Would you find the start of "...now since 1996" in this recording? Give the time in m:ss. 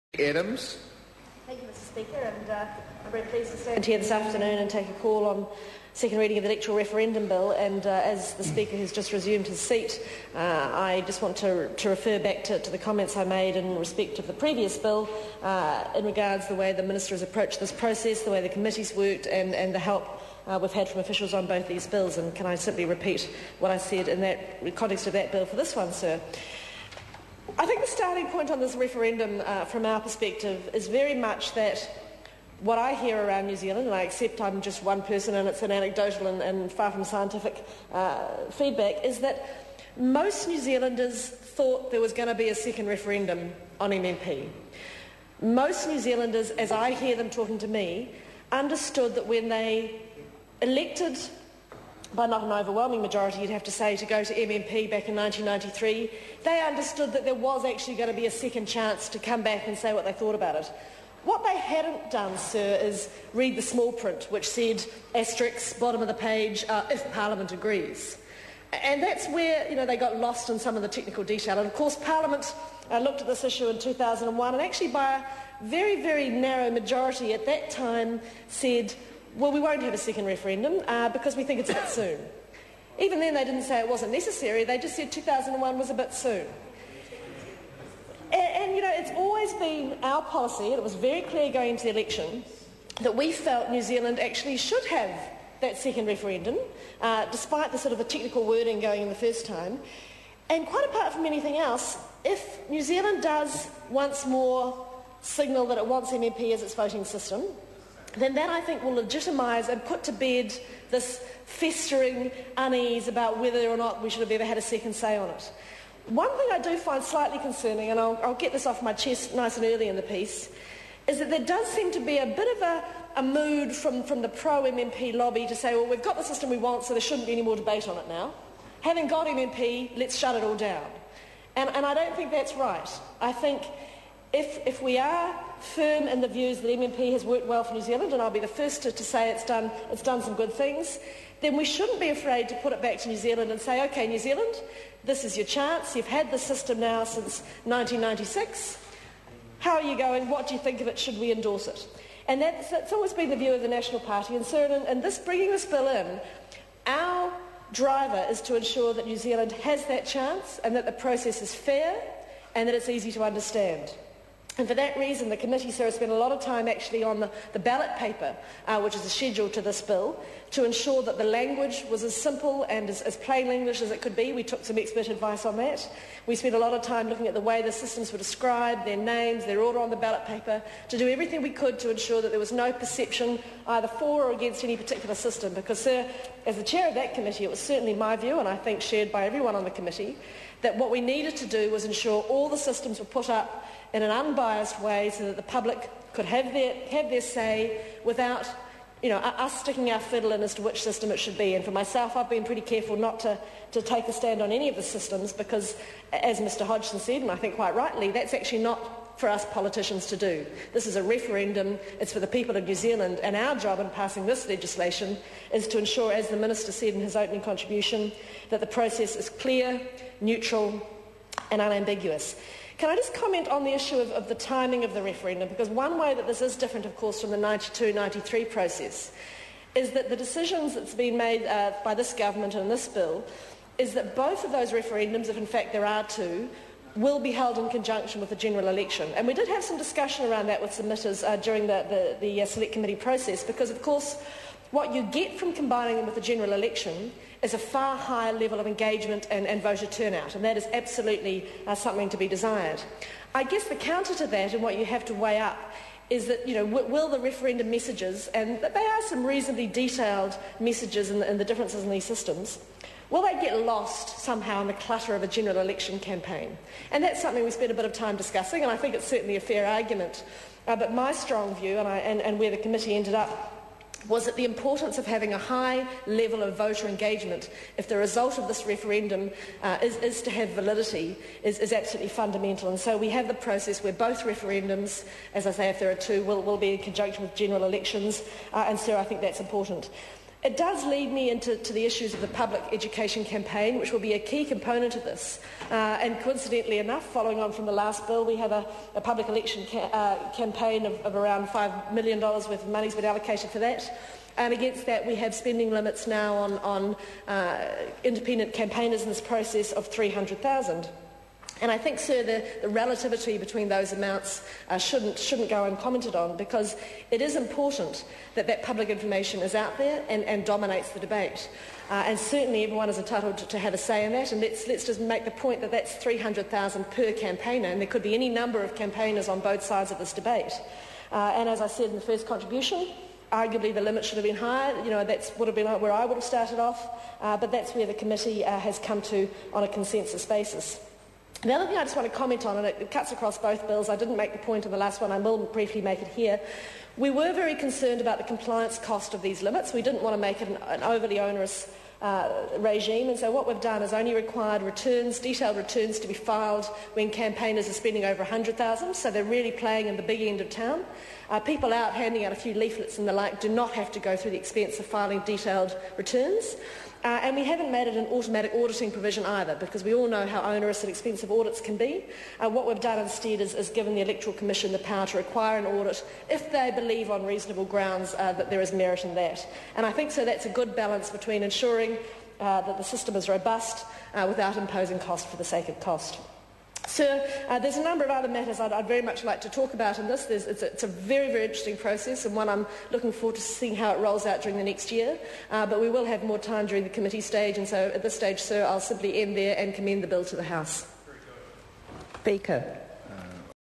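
2:26.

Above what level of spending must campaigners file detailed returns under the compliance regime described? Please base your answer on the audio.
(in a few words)
100,000.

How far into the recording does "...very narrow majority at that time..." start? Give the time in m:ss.
1:16.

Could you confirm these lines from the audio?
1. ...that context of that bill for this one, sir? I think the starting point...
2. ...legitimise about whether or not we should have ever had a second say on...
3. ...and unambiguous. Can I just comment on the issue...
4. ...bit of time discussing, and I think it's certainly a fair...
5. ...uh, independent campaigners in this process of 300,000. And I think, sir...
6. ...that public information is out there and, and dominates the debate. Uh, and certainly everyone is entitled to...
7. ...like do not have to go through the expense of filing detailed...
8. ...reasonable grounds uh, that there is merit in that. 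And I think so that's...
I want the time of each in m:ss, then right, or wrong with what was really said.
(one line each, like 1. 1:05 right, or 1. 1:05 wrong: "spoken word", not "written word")
1. 0:24 right
2. 1:52 wrong: "unease", not "legitimise"
3. 3:41 right
4. 4:27 right
5. 5:07 right
6. 5:18 right
7. 6:03 right
8. 6:17 right.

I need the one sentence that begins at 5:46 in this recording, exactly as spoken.
We were very concerned about the compliance cost of these limits.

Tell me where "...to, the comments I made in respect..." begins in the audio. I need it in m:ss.
0:12.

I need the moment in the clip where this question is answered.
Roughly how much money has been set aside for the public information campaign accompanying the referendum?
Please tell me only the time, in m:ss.
5:01.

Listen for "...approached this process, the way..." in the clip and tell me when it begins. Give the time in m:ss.
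0:17.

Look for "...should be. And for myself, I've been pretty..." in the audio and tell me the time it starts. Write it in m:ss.
3:21.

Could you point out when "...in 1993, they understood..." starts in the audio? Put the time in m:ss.
0:55.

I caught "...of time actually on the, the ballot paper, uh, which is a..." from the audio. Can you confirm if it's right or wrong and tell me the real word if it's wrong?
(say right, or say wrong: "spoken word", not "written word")
right.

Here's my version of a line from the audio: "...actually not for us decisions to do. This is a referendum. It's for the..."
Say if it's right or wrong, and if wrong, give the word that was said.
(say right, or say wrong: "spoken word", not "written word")
wrong: "politicians", not "decisions".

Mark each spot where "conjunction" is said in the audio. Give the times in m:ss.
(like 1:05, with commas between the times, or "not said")
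3:57, 4:46.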